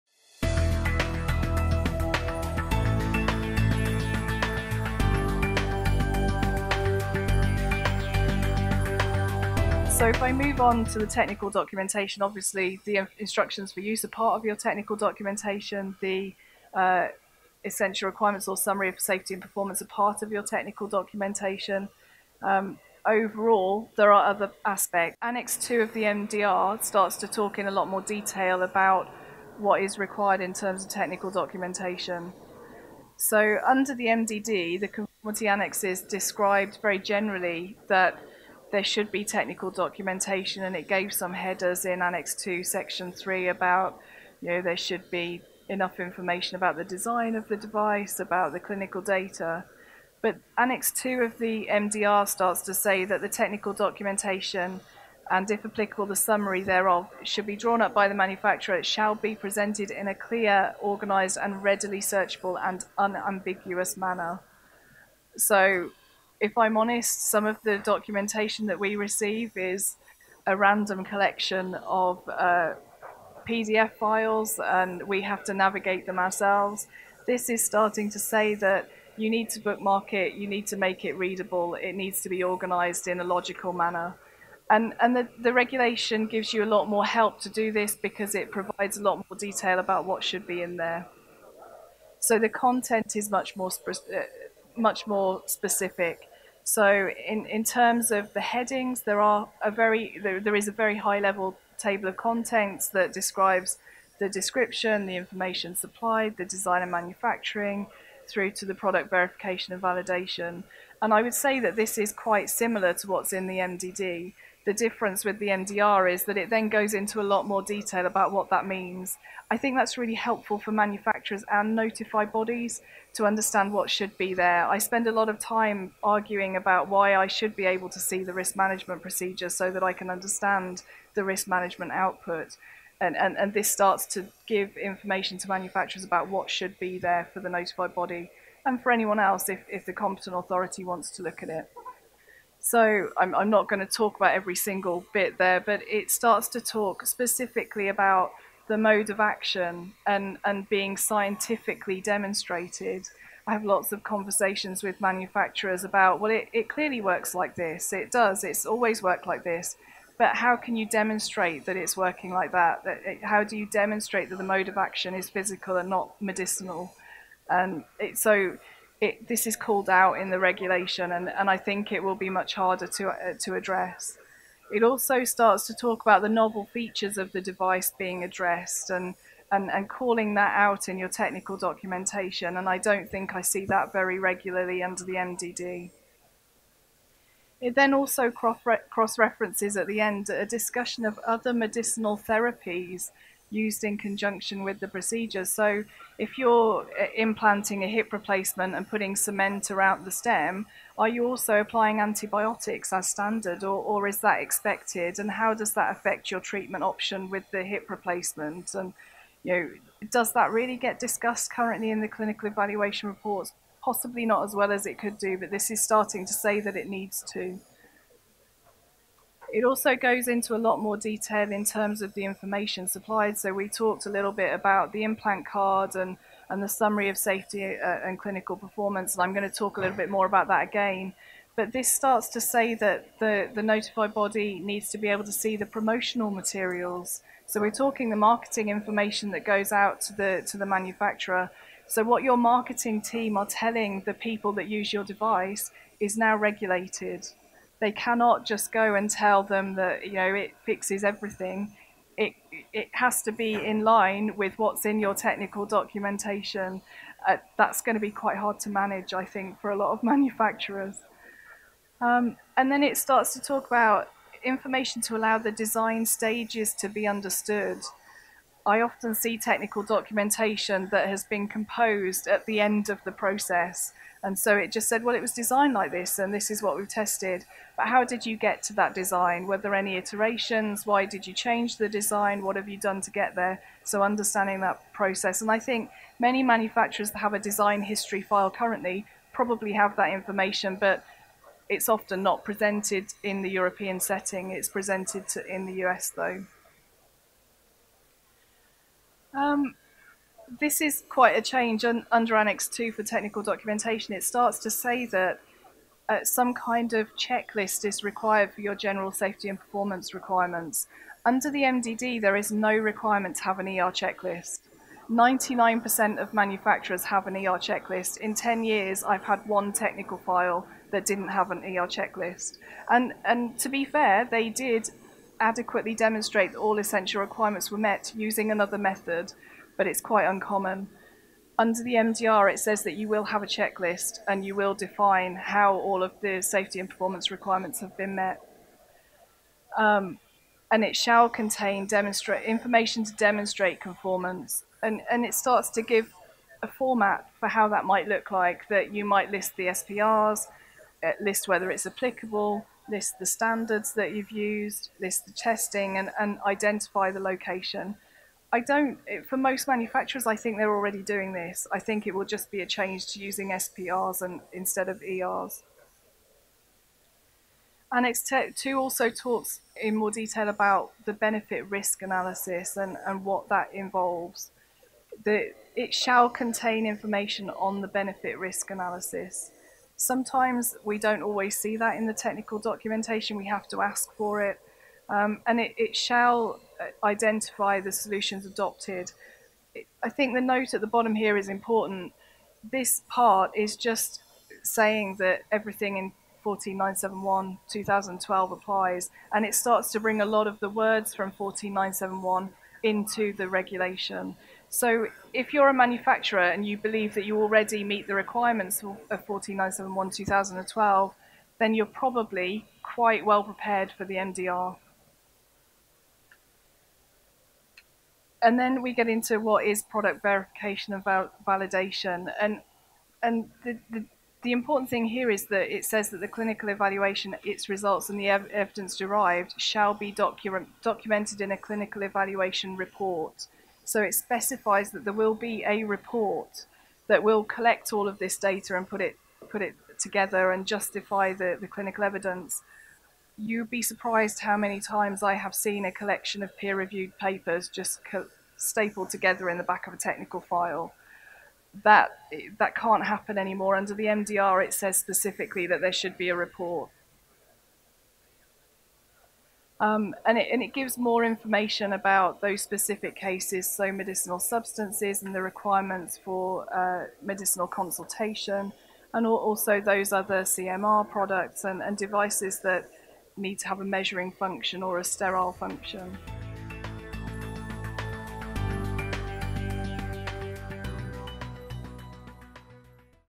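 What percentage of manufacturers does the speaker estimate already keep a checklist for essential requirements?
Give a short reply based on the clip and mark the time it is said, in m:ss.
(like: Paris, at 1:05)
99%, at 5:15.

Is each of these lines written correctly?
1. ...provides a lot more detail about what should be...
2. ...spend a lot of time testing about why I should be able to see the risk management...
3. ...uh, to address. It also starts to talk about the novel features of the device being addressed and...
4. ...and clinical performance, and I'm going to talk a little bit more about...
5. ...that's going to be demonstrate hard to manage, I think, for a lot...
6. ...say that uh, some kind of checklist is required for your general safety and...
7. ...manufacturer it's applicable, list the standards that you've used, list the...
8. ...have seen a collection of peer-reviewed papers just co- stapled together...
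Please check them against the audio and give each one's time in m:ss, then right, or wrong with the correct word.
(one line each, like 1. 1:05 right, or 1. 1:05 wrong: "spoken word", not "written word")
1. 1:28 right
2. 2:04 wrong: "arguing", not "testing"
3. 2:53 right
4. 3:48 right
5. 4:17 wrong: "quite", not "demonstrate"
6. 5:04 right
7. 5:51 wrong: "whether", not "manufacturer"
8. 7:25 right.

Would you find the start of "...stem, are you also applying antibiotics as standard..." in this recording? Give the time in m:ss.
3:20.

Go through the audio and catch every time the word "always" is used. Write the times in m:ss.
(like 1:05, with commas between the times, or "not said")
2:38, 6:21.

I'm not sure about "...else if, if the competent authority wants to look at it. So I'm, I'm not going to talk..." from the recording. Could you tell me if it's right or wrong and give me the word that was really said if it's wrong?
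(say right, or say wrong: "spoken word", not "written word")
right.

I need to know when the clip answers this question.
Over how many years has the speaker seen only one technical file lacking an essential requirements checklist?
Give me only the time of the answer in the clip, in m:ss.
5:18.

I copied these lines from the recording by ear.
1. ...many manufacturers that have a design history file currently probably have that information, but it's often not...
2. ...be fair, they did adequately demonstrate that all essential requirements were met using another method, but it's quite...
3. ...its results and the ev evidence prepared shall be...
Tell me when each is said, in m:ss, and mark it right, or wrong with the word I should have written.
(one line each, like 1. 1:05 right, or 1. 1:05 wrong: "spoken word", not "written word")
1. 4:46 right
2. 5:23 right
3. 7:07 wrong: "derived", not "prepared".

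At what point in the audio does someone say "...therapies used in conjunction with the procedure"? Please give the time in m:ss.
3:12.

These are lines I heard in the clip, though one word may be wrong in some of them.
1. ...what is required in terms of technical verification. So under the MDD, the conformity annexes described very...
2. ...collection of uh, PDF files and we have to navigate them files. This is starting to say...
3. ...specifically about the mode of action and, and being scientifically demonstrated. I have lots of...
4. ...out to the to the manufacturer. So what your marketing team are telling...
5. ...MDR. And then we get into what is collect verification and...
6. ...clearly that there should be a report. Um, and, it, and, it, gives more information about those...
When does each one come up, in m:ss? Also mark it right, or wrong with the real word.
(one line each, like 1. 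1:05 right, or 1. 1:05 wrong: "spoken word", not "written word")
1. 0:29 wrong: "documentation", not "verification"
2. 1:11 wrong: "ourselves", not "files"
3. 2:27 right
4. 3:59 right
5. 6:54 wrong: "product", not "collect"
6. 7:34 wrong: "specifically", not "clearly".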